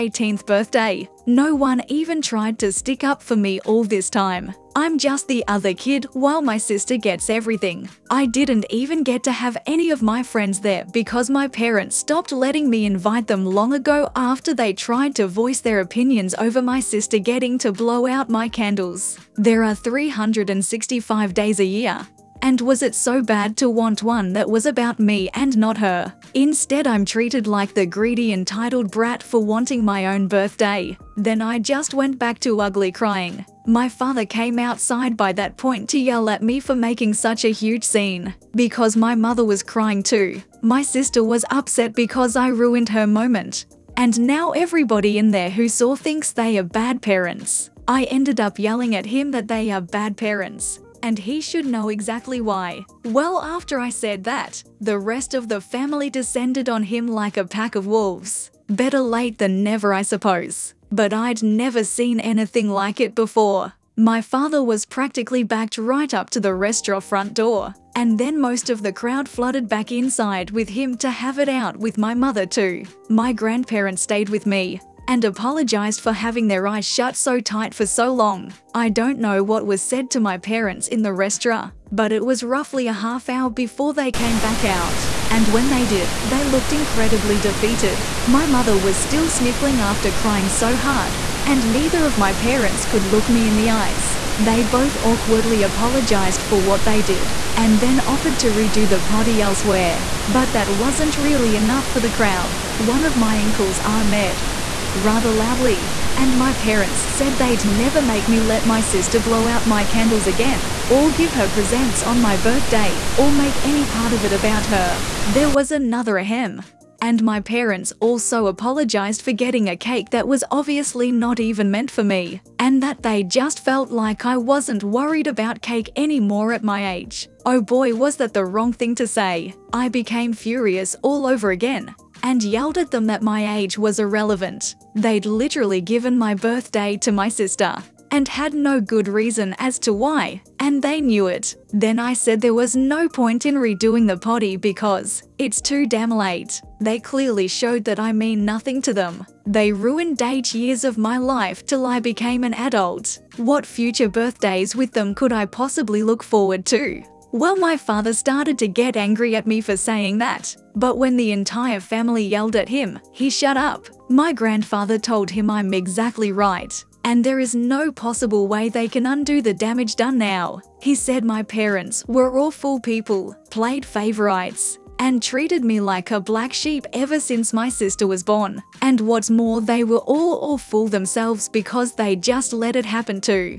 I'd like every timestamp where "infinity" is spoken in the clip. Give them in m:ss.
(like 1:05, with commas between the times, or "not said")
not said.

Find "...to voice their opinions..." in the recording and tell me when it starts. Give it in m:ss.
0:15.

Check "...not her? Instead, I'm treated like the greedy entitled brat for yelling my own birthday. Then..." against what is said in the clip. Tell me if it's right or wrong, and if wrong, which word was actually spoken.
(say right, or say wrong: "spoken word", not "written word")
wrong: "wanting", not "yelling".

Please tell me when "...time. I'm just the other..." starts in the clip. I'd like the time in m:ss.
0:04.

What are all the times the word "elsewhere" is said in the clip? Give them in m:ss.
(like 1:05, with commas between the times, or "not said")
1:39.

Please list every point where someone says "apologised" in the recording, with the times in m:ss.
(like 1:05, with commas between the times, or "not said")
1:15, 1:35, 1:58.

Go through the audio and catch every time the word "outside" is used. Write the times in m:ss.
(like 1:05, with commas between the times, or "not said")
0:34.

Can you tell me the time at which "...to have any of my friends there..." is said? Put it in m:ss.
0:09.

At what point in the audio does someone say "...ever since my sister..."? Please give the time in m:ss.
2:56.